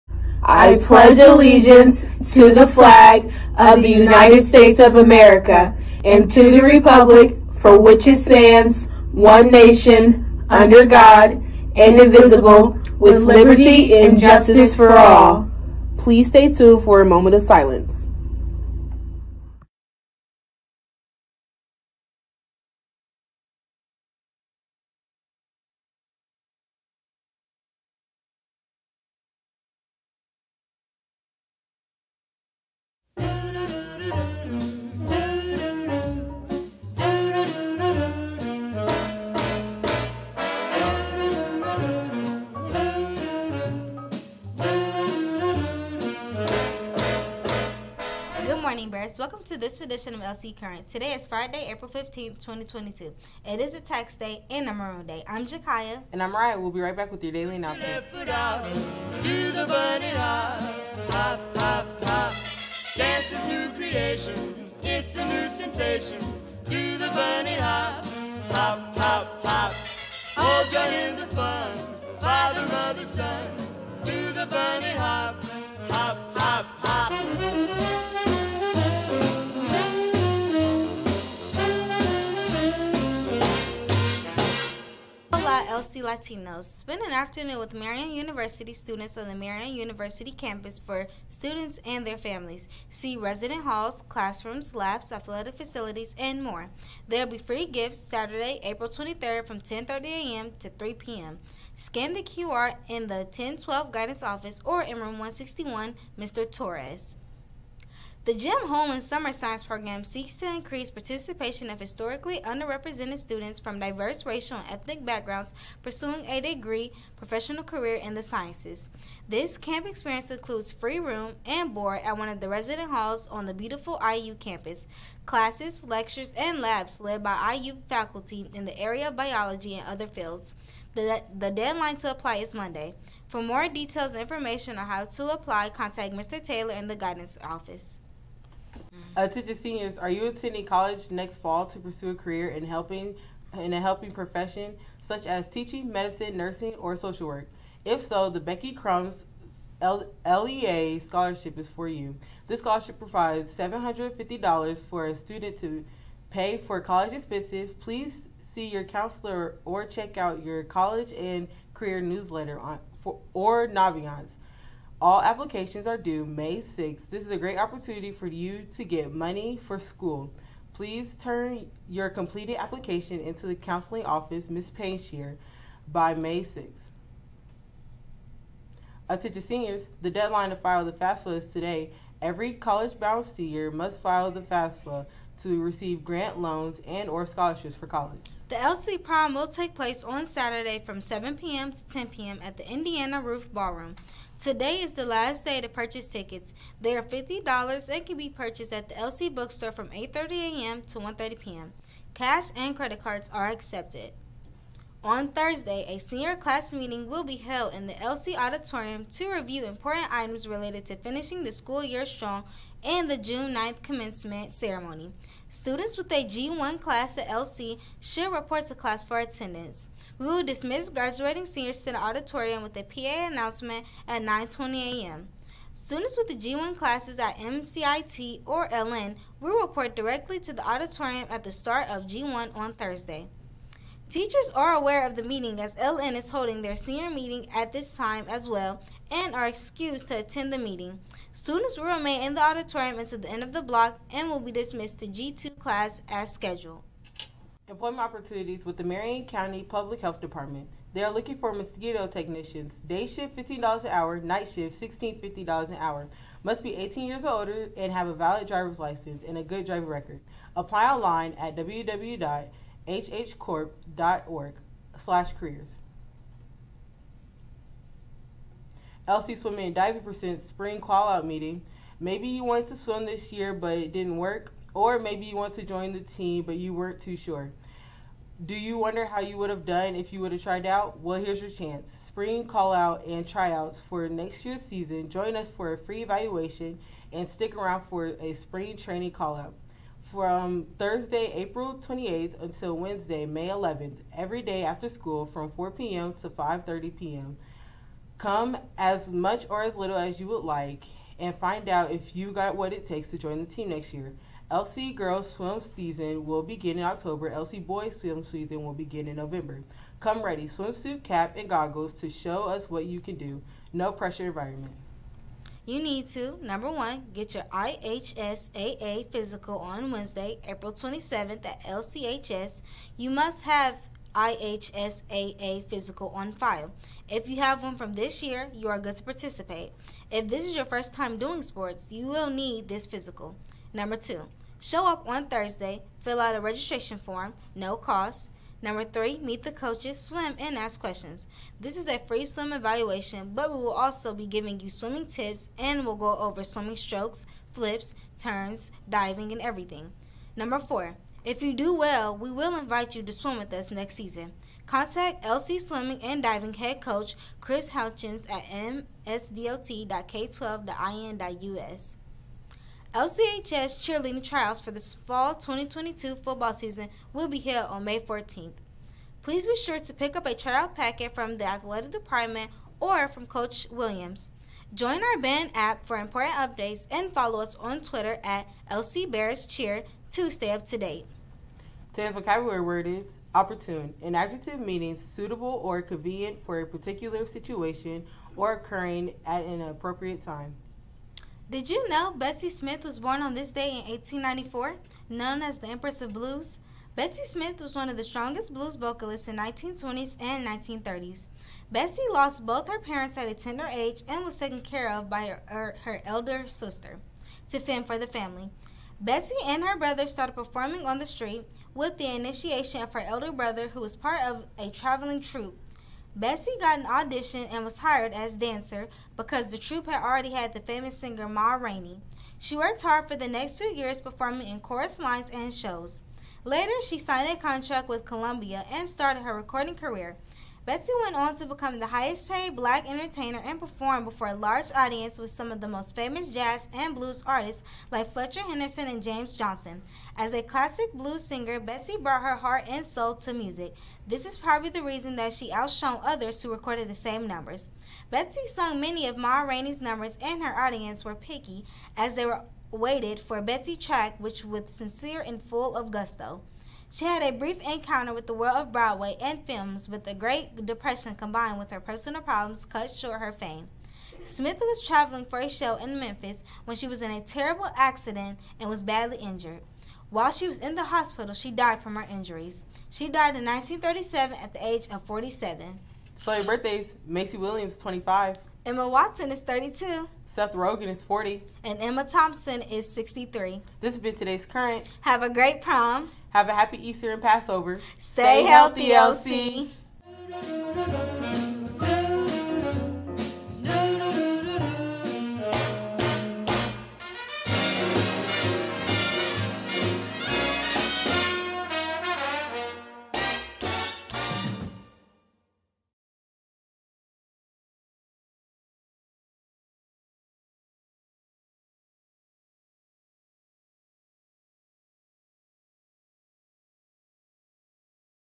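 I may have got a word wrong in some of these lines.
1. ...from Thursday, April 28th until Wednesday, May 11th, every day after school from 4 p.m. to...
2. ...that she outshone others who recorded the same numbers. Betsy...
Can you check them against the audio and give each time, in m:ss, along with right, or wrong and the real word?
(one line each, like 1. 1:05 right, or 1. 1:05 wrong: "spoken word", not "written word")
1. 4:50 right
2. 7:25 right.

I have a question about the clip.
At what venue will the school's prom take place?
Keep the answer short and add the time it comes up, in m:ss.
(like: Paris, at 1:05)
Indiana Roof Ballroom, at 3:12.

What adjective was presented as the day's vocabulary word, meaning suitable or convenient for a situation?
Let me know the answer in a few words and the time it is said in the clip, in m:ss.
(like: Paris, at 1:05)
opportune, at 6:23.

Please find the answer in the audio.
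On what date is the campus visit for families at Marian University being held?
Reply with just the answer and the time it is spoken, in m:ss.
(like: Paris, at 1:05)
Saturday, April 23rd, at 1:37.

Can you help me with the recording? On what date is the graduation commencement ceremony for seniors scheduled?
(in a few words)
June 9th.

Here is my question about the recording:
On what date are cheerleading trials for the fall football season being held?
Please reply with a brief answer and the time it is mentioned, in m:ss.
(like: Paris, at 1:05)
May 14th, at 6:07.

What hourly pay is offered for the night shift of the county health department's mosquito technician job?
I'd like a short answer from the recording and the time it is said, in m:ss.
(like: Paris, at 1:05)
$16.50, at 4:14.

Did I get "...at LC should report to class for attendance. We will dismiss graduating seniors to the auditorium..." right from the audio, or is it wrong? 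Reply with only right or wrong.
right.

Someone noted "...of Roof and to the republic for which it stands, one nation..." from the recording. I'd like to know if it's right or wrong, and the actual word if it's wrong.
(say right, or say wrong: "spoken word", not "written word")
wrong: "America", not "Roof".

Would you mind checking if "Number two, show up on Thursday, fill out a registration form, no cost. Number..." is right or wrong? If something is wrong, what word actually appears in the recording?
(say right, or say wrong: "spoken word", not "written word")
right.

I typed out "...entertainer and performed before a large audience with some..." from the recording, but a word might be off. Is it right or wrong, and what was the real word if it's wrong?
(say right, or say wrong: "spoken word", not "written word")
right.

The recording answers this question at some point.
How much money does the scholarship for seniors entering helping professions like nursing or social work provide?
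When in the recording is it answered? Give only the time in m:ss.
2:33.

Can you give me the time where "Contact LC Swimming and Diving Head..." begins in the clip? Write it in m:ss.
5:54.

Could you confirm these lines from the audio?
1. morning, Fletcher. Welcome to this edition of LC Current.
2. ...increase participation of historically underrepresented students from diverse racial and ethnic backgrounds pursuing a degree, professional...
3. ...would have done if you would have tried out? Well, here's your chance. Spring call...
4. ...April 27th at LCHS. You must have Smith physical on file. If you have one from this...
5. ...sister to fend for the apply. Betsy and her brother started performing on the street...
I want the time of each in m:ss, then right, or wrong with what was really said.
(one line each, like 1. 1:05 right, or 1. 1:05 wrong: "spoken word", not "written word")
1. 0:48 wrong: "Bears", not "Fletcher"
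2. 1:50 right
3. 4:39 right
4. 5:20 wrong: "IHSAA", not "Smith"
5. 6:46 wrong: "family", not "apply".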